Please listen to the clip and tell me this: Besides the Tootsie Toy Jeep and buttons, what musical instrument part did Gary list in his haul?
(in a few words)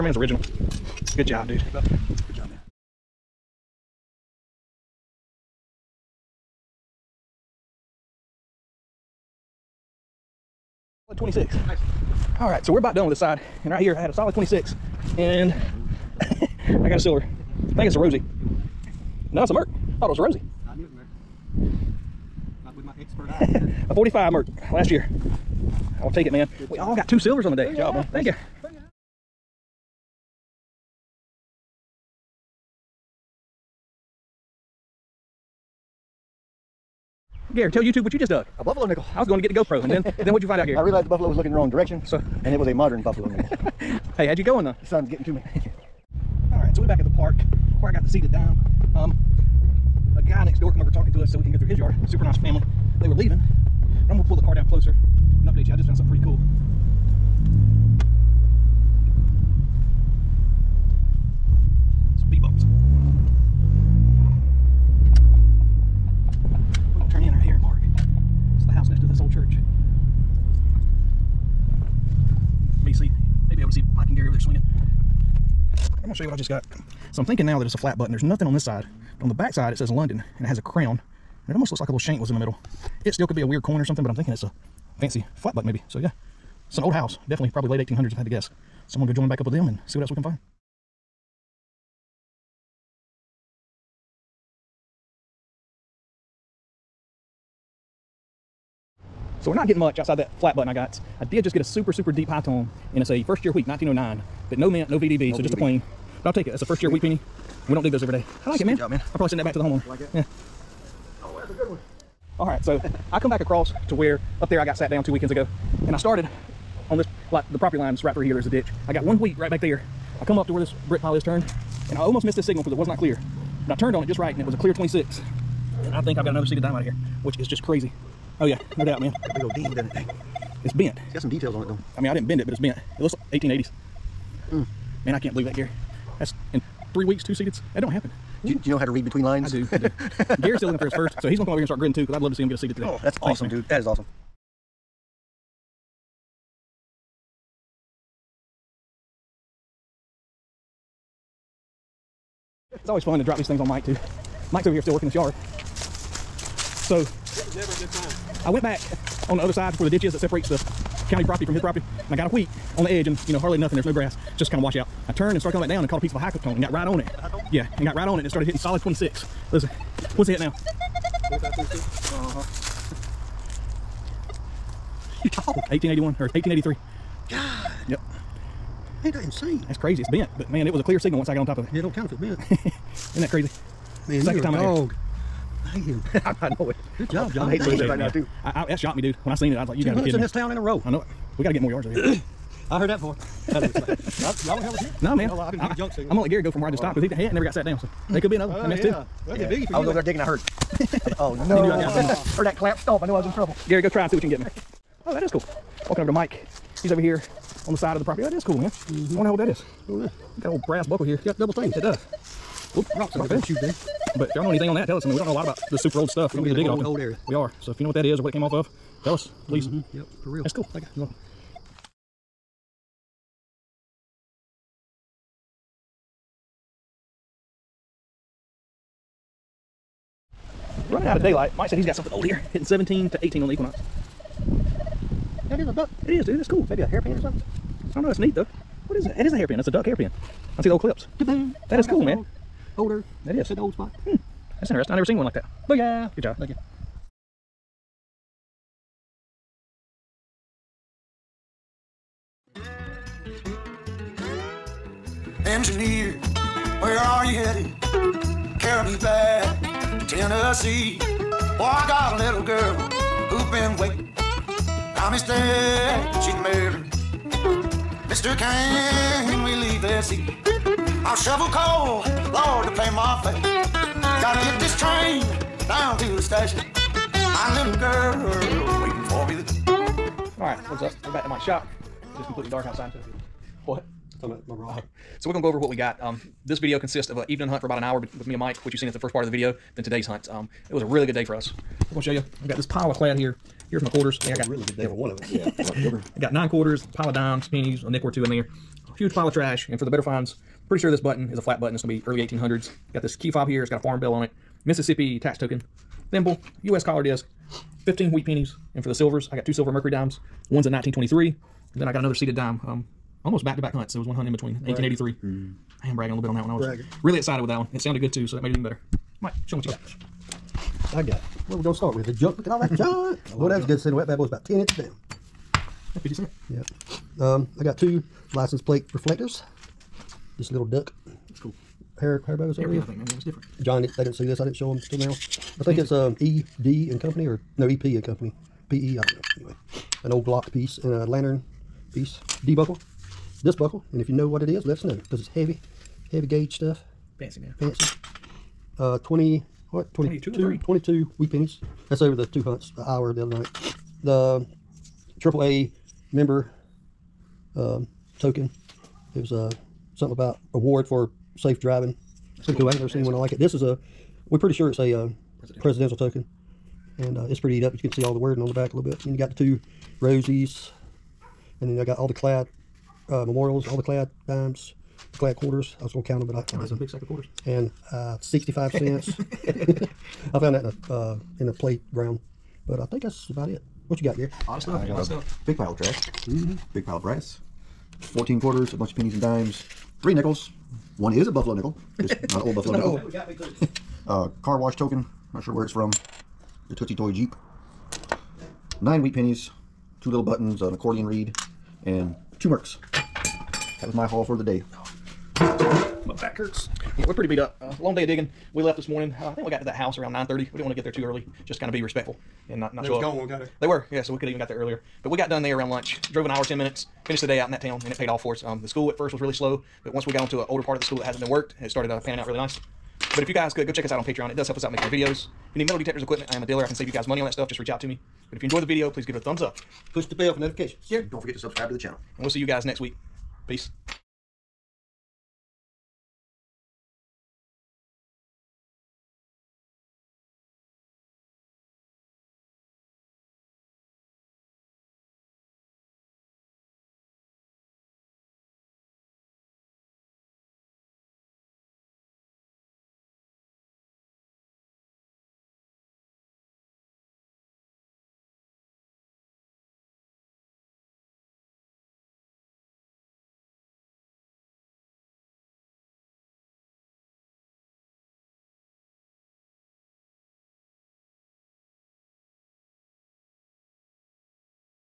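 Accordion reed.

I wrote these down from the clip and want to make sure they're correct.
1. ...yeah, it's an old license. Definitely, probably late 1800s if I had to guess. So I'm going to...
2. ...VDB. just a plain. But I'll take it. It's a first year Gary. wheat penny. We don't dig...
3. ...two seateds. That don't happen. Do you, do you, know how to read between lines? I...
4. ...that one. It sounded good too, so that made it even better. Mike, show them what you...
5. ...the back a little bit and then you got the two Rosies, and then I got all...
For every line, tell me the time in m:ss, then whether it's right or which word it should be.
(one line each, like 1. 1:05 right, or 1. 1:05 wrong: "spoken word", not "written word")
1. 1:25 wrong: "house", not "license"
2. 1:45 wrong: "Sweet", not "Gary"
3. 2:17 right
4. 5:17 right
5. 6:08 right.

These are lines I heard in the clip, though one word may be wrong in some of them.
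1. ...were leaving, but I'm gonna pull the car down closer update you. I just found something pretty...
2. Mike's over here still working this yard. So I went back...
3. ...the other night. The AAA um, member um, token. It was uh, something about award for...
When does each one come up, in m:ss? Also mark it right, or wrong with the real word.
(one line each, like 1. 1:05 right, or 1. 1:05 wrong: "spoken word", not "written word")
1. 0:53 right
2. 2:34 right
3. 5:53 right.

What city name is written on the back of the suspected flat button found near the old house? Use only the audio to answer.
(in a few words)
London.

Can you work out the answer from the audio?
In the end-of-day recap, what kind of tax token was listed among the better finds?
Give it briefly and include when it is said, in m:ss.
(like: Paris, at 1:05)
Mississippi tax token, at 5:04.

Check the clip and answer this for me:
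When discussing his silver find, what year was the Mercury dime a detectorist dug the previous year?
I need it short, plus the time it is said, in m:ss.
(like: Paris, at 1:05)
1945, at 0:23.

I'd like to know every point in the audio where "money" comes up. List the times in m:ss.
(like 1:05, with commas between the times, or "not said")
7:07.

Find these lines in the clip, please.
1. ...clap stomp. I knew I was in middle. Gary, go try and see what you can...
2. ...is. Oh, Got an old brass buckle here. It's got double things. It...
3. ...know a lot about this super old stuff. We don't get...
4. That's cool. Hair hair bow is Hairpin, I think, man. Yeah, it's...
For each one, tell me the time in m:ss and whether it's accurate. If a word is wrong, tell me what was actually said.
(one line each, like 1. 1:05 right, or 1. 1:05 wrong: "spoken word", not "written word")
1. 3:22 wrong: "trouble", not "middle"
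2. 3:29 right
3. 3:35 right
4. 5:31 right.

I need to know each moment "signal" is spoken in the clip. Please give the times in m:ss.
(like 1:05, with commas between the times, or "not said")
2:02, 3:00.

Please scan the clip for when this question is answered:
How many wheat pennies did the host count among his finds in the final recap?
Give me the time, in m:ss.
5:07.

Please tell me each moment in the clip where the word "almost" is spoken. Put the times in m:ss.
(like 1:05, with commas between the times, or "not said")
1:21, 2:01, 5:13.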